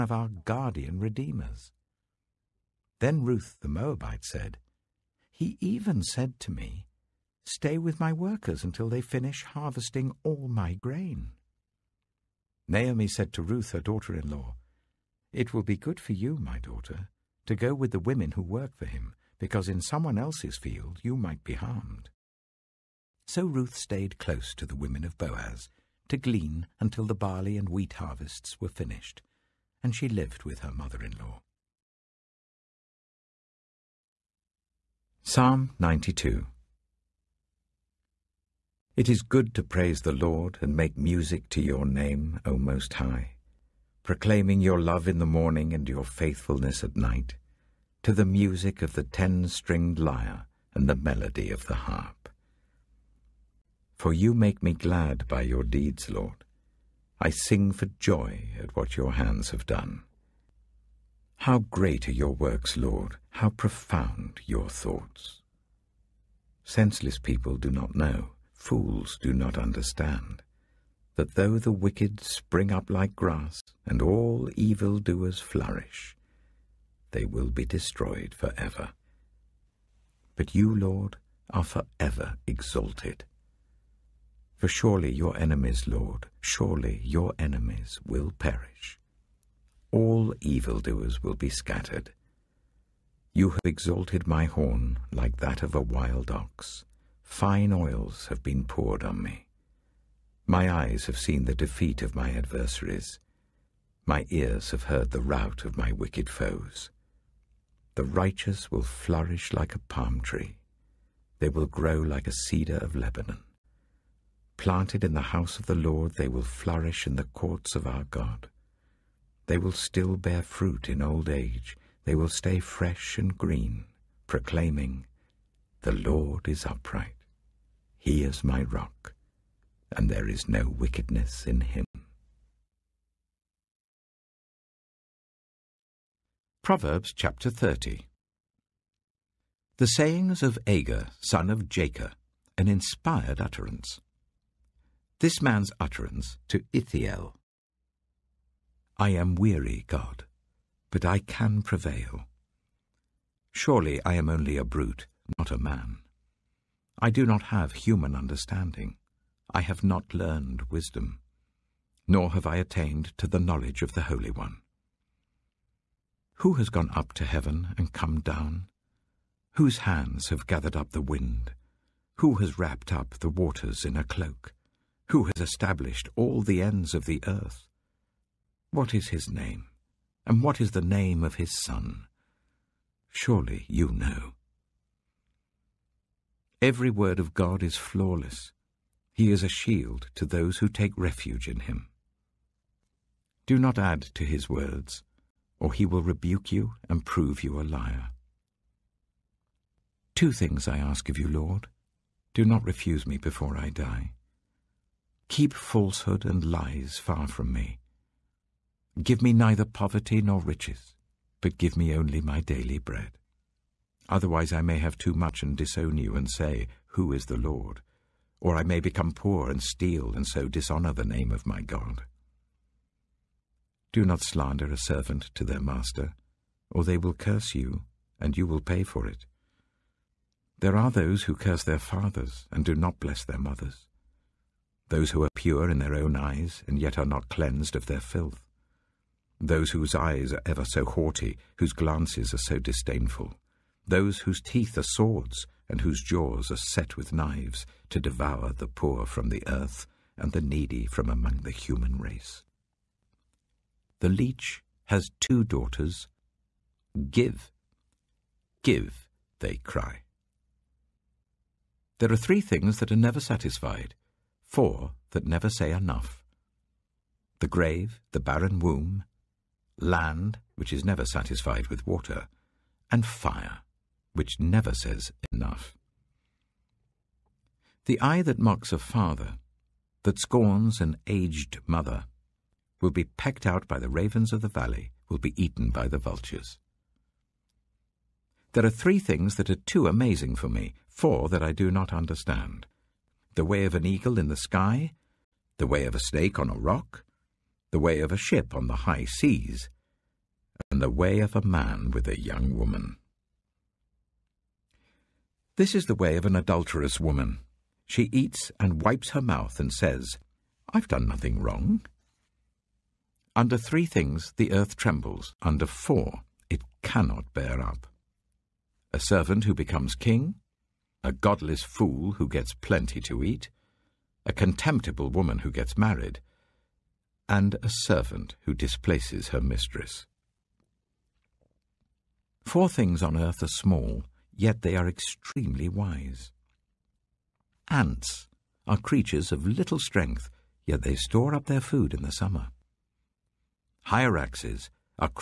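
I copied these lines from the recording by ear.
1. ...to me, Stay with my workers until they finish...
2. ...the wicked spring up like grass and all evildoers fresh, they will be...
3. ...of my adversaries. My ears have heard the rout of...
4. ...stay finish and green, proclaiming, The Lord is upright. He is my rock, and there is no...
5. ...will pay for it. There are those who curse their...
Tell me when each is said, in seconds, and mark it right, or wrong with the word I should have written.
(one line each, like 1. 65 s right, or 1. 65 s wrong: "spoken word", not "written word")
1. 6 s right
2. 71 s wrong: "flourish", not "fresh"
3. 102 s right
4. 122 s wrong: "fresh", not "finish"
5. 228 s right.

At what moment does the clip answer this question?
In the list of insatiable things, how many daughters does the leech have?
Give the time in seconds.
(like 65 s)
255 s.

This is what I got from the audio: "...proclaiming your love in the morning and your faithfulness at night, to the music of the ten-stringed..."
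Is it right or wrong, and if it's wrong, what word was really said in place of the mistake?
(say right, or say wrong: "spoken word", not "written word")
right.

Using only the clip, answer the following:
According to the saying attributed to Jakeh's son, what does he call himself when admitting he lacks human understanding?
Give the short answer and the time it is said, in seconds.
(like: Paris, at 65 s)
a brute, at 154 s.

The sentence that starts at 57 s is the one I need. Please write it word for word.
I sing for joy at what your hands have done.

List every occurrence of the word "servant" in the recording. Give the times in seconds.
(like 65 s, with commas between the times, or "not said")
224 s, 318 s, 327 s.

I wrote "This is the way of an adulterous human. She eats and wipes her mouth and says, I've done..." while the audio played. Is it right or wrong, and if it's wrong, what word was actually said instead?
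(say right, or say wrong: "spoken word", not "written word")
wrong: "woman", not "human".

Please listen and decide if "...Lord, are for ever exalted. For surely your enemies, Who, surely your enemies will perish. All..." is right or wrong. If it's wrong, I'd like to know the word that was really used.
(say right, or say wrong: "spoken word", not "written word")
wrong: "Lord", not "Who".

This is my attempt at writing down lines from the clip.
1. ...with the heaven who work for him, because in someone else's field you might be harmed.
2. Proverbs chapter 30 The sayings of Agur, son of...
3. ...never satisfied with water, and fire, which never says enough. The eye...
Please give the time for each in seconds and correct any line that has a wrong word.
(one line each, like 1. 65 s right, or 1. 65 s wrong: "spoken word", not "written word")
1. 17 s wrong: "women", not "heaven"
2. 136 s right
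3. 270 s right.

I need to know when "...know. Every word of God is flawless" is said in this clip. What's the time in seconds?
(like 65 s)
183 s.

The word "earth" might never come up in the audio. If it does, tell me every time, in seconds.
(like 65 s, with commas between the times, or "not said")
177 s, 249 s, 314 s, 333 s.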